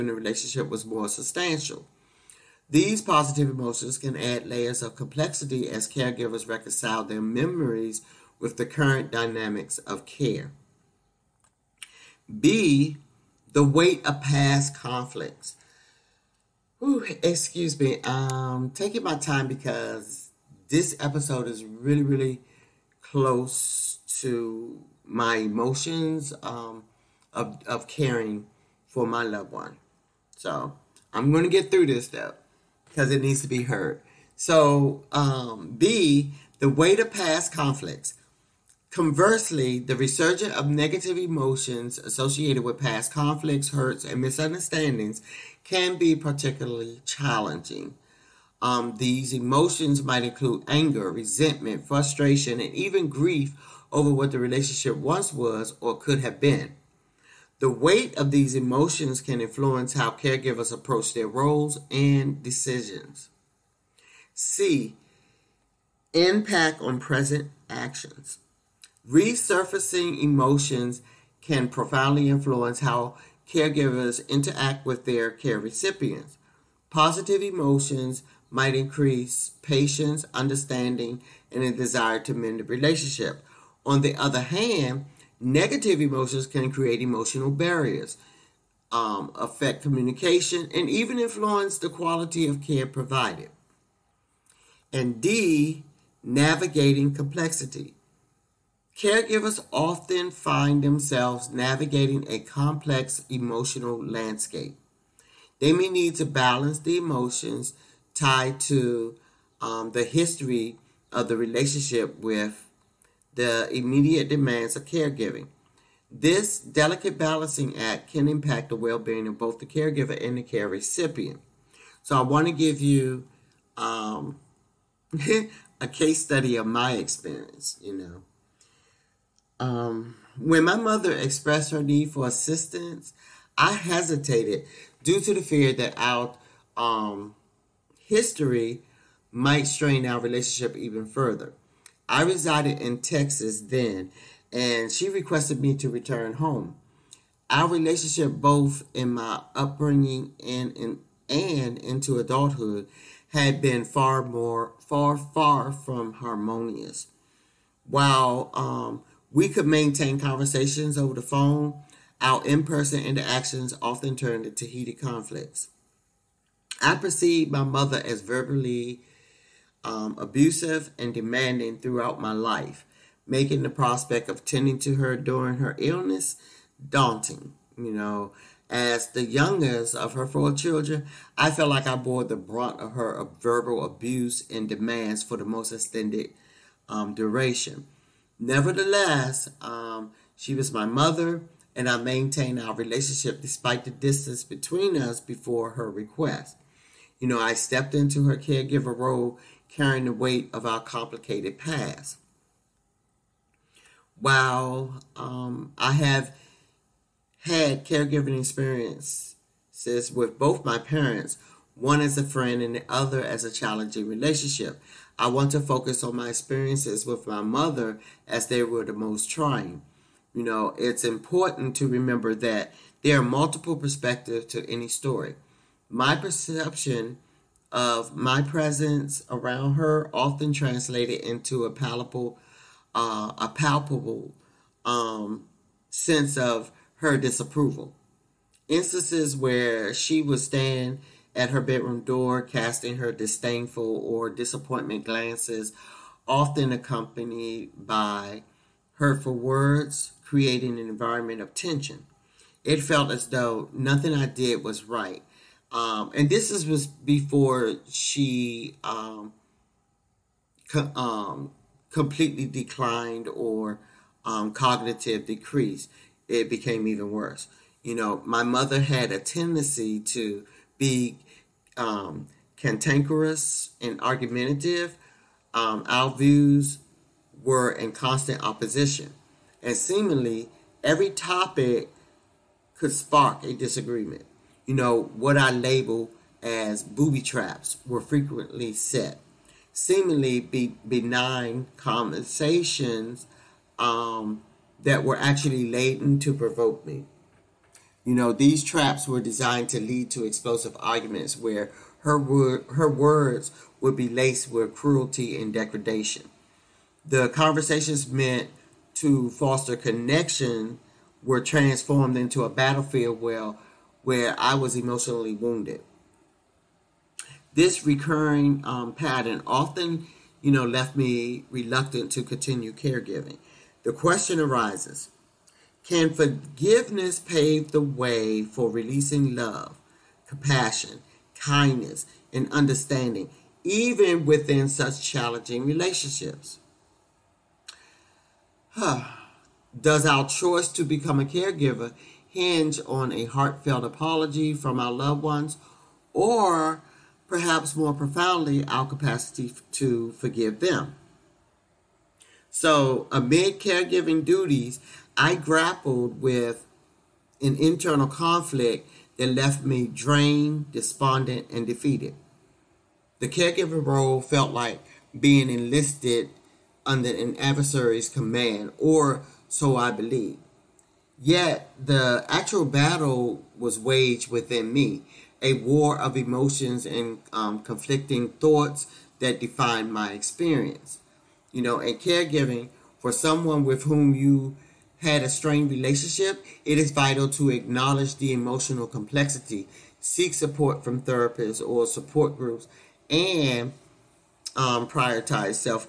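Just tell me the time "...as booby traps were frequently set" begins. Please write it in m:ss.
4:46.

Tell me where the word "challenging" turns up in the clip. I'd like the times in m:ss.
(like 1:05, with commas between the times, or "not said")
0:47, 3:33, 5:35.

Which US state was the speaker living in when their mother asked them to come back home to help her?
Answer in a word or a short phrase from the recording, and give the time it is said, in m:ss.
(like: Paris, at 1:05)
Texas, at 2:23.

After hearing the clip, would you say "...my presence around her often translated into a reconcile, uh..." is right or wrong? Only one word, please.
wrong.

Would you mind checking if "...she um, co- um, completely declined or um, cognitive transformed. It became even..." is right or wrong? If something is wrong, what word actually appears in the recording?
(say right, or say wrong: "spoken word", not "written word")
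wrong: "decreased", not "transformed".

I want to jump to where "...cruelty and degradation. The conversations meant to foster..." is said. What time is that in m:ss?
5:04.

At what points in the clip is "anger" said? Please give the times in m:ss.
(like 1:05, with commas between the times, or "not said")
0:50.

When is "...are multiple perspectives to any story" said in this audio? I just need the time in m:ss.
3:43.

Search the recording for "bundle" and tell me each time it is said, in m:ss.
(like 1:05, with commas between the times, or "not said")
not said.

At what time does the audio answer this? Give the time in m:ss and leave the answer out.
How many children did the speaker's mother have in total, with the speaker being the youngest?
3:00.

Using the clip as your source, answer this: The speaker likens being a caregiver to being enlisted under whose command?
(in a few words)
an adversary's.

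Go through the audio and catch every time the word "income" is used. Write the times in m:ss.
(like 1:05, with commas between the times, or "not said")
not said.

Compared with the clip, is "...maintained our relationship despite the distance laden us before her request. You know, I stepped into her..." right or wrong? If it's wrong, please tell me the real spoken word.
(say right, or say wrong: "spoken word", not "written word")
wrong: "between", not "laden".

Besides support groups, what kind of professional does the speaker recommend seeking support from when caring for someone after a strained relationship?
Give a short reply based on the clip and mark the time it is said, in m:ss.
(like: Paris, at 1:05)
therapists, at 6:31.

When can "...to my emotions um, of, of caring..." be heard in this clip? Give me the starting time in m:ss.
0:24.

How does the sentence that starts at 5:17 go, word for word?
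This recurring um, pattern often, you know, left me reluctant to continue caregiving.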